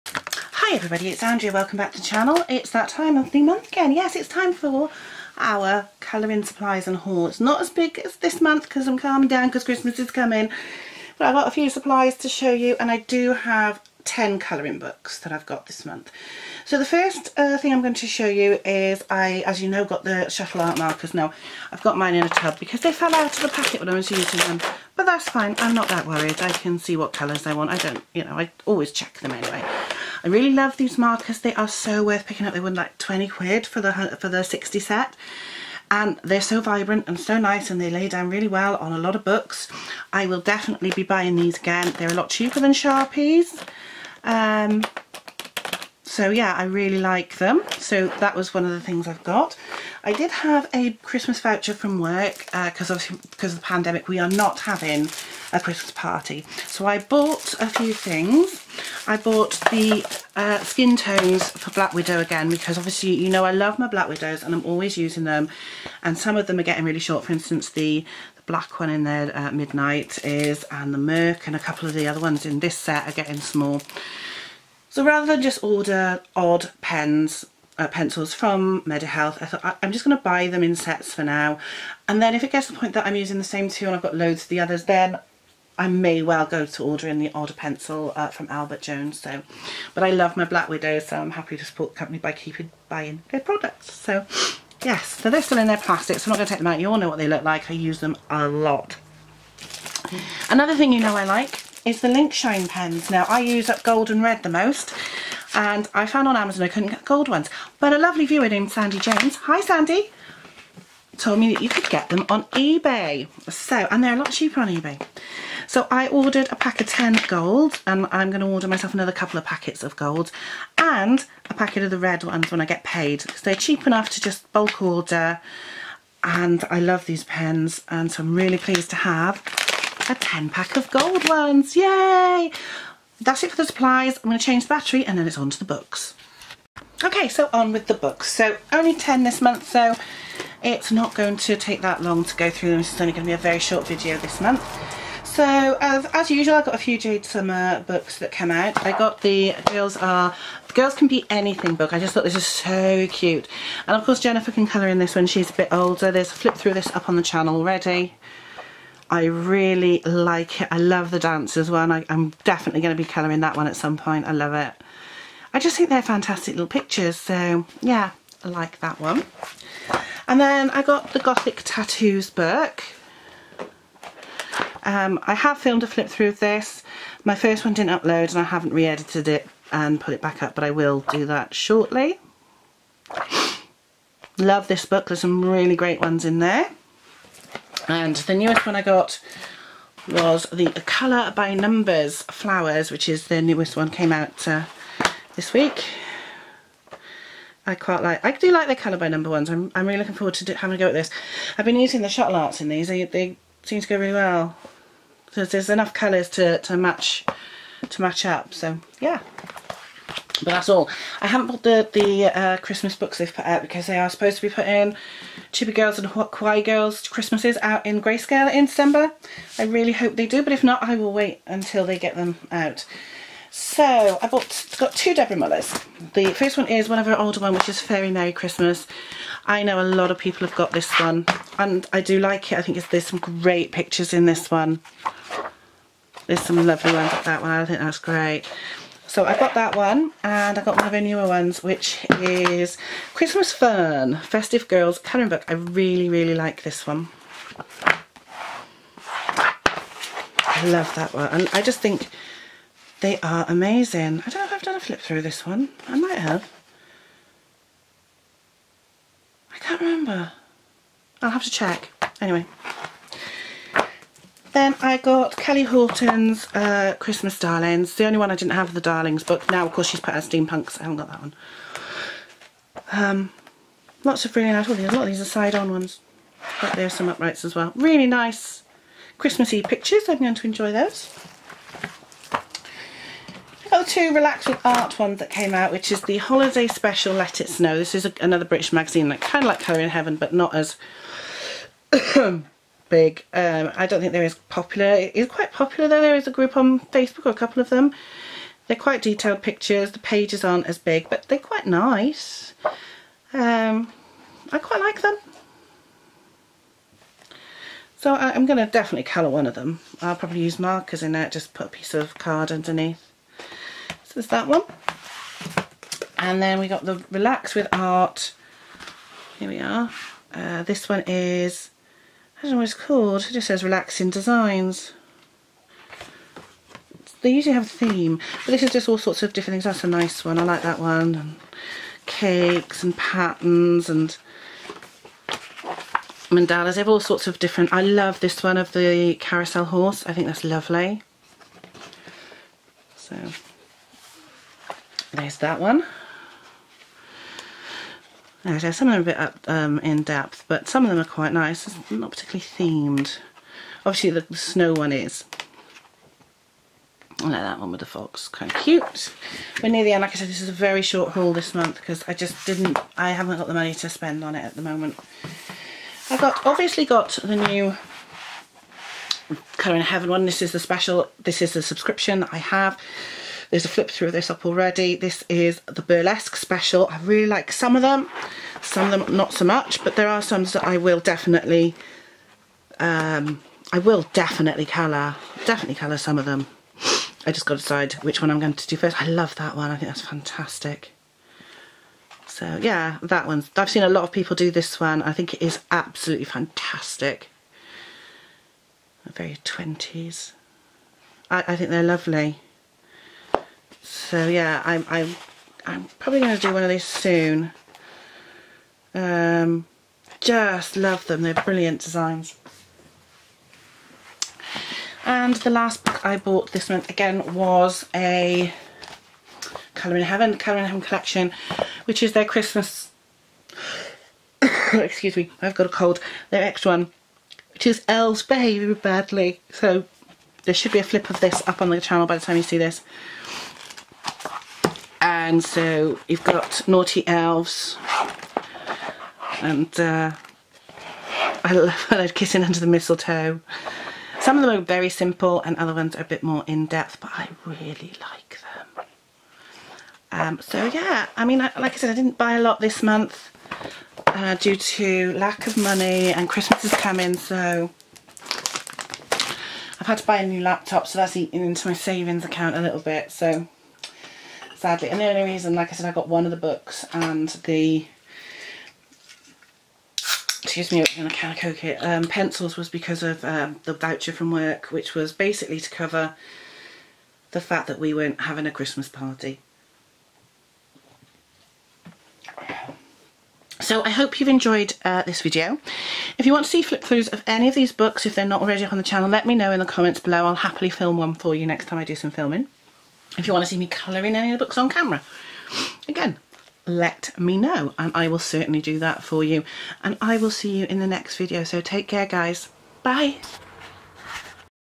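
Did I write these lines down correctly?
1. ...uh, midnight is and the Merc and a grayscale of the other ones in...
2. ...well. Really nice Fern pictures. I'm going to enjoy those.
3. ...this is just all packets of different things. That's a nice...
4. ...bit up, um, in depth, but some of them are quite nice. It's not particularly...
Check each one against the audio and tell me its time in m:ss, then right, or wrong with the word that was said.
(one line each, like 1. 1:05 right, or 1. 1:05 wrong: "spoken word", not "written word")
1. 1:09 wrong: "couple", not "grayscale"
2. 4:37 wrong: "Christmassy", not "Fern"
3. 5:28 wrong: "sorts", not "packets"
4. 5:49 right.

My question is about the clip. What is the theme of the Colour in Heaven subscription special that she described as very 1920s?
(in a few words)
Burlesque.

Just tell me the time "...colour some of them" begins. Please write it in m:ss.
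6:25.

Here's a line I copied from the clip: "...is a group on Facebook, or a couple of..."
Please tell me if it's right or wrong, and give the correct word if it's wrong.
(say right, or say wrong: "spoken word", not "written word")
right.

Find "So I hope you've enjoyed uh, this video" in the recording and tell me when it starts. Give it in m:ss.
8:03.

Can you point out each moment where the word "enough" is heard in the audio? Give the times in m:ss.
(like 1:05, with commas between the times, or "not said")
2:03, 3:25.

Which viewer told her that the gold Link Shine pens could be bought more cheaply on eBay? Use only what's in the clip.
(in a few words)
Sandy James.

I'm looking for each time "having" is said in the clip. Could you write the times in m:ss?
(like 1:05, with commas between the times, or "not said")
0:54, 3:20, 7:58.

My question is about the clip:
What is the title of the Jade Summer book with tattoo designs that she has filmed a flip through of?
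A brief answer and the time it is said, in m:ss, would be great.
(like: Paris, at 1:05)
Gothic Tattoos, at 2:51.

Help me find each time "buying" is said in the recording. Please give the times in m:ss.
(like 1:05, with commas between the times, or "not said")
0:41, 1:32.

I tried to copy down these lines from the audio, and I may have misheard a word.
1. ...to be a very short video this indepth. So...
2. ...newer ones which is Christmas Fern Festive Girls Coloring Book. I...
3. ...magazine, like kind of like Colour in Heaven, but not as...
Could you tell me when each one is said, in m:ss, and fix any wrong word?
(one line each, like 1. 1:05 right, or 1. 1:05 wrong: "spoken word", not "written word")
1. 2:23 wrong: "month", not "indepth"
2. 4:01 right
3. 4:48 right.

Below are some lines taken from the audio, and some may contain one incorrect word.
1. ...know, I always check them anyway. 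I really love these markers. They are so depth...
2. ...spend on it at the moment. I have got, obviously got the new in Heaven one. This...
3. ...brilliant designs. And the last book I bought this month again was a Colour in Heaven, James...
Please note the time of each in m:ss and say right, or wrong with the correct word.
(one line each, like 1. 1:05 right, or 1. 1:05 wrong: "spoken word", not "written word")
1. 0:28 wrong: "worth", not "depth"
2. 6:03 right
3. 6:51 wrong: "Colour", not "James".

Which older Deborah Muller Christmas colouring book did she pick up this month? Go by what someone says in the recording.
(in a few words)
Fairy Merry Christmas.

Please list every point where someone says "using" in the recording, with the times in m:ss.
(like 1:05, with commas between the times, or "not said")
0:24, 1:04, 1:23, 3:21.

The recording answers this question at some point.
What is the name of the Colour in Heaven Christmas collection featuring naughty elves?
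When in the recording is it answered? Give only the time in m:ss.
7:07.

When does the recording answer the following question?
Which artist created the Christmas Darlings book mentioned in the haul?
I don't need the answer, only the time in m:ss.
4:25.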